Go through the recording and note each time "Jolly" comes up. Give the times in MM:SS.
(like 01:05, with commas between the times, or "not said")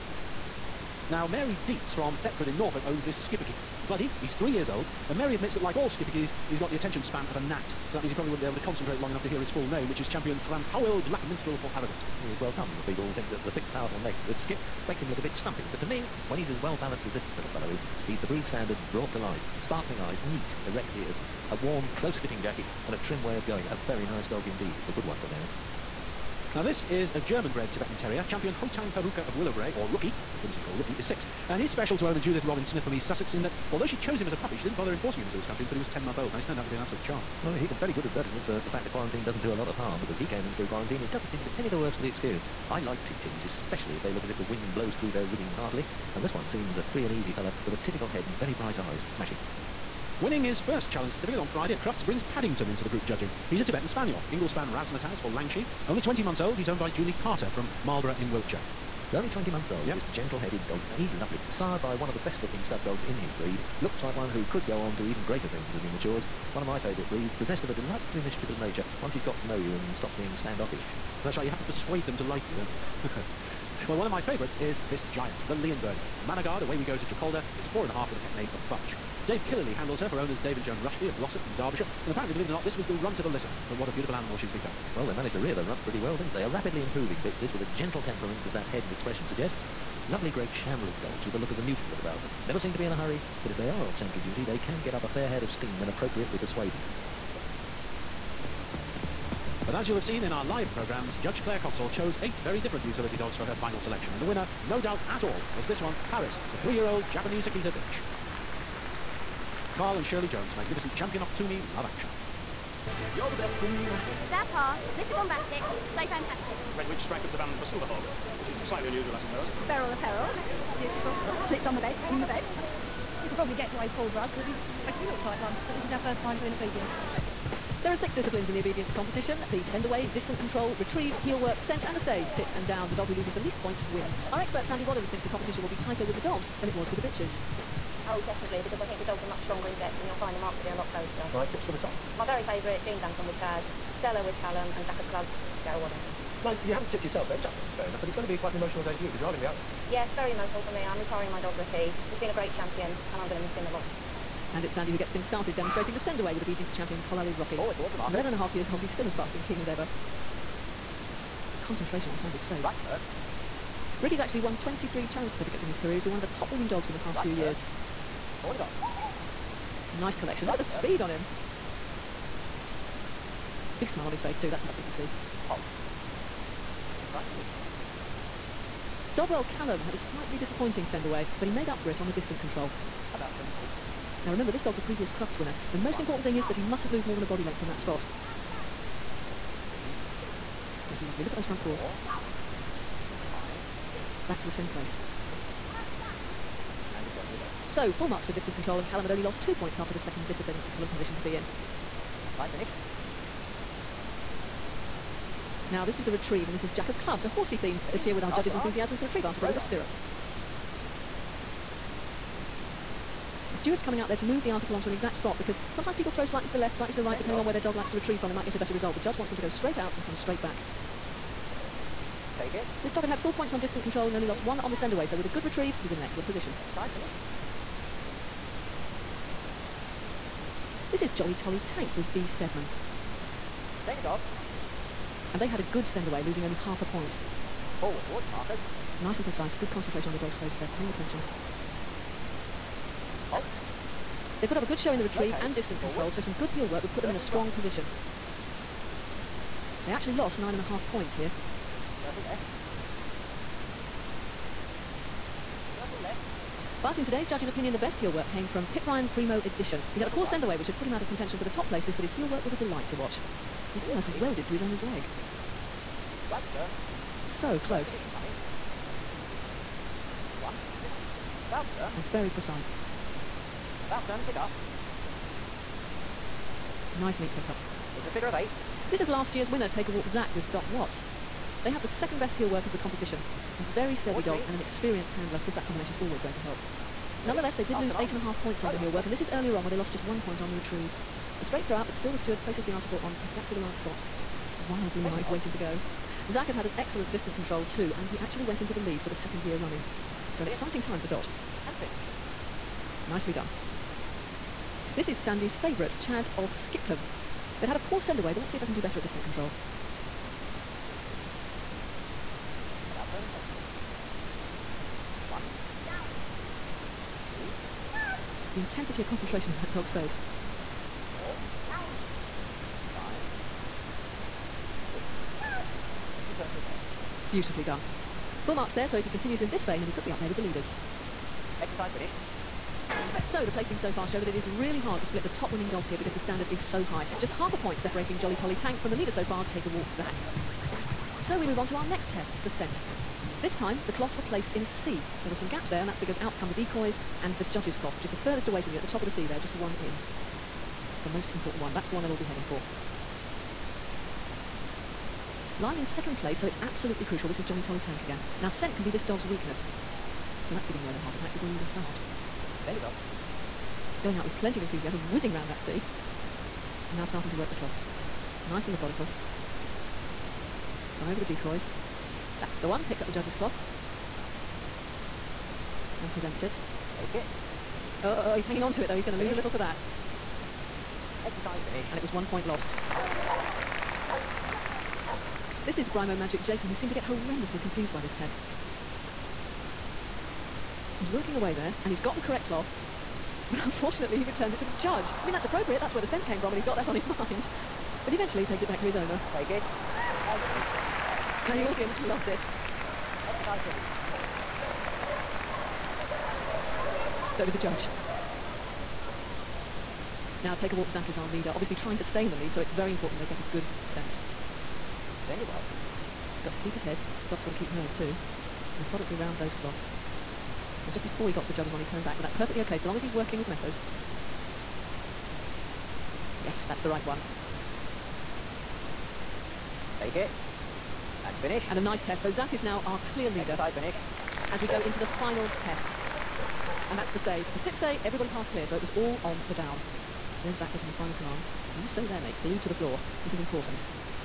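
03:51, 05:38, 05:57.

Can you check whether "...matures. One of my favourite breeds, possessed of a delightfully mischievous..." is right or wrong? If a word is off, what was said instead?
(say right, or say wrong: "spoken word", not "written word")
right.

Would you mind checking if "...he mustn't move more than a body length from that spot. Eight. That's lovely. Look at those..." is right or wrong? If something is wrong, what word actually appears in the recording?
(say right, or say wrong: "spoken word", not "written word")
wrong: "Three", not "Eight".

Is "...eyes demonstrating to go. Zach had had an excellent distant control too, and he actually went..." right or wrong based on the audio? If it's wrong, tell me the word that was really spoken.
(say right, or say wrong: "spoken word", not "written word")
wrong: "waiting", not "demonstrating".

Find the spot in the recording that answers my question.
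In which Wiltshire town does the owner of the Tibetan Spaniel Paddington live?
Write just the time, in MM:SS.
00:57.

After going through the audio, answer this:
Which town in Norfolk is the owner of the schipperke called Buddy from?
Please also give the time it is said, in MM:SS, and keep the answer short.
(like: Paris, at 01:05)
Thetford, at 00:02.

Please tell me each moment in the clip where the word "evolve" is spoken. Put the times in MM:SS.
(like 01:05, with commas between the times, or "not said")
not said.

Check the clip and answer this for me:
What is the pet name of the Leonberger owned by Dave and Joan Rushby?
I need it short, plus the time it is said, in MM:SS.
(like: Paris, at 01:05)
Fudge, at 01:18.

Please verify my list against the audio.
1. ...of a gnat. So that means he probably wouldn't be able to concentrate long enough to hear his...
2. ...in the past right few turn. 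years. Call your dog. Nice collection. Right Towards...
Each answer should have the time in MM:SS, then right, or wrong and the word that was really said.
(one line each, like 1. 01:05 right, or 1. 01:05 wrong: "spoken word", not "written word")
1. 00:07 right
2. 02:46 wrong: "Look", not "Towards".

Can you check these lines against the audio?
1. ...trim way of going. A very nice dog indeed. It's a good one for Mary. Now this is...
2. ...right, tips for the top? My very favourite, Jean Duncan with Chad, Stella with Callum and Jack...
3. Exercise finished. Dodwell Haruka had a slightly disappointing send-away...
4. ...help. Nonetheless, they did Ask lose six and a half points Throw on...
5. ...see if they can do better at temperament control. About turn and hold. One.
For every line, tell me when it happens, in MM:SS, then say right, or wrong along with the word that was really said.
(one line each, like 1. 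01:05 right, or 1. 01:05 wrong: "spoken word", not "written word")
1. 00:23 right
2. 02:21 right
3. 02:56 wrong: "Callum", not "Haruka"
4. 04:46 wrong: "eight", not "six"
5. 05:08 wrong: "distant", not "temperament".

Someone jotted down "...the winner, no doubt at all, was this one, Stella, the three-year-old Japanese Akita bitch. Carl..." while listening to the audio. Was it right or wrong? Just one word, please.
wrong.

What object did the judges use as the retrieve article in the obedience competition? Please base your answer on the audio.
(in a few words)
A stirrup.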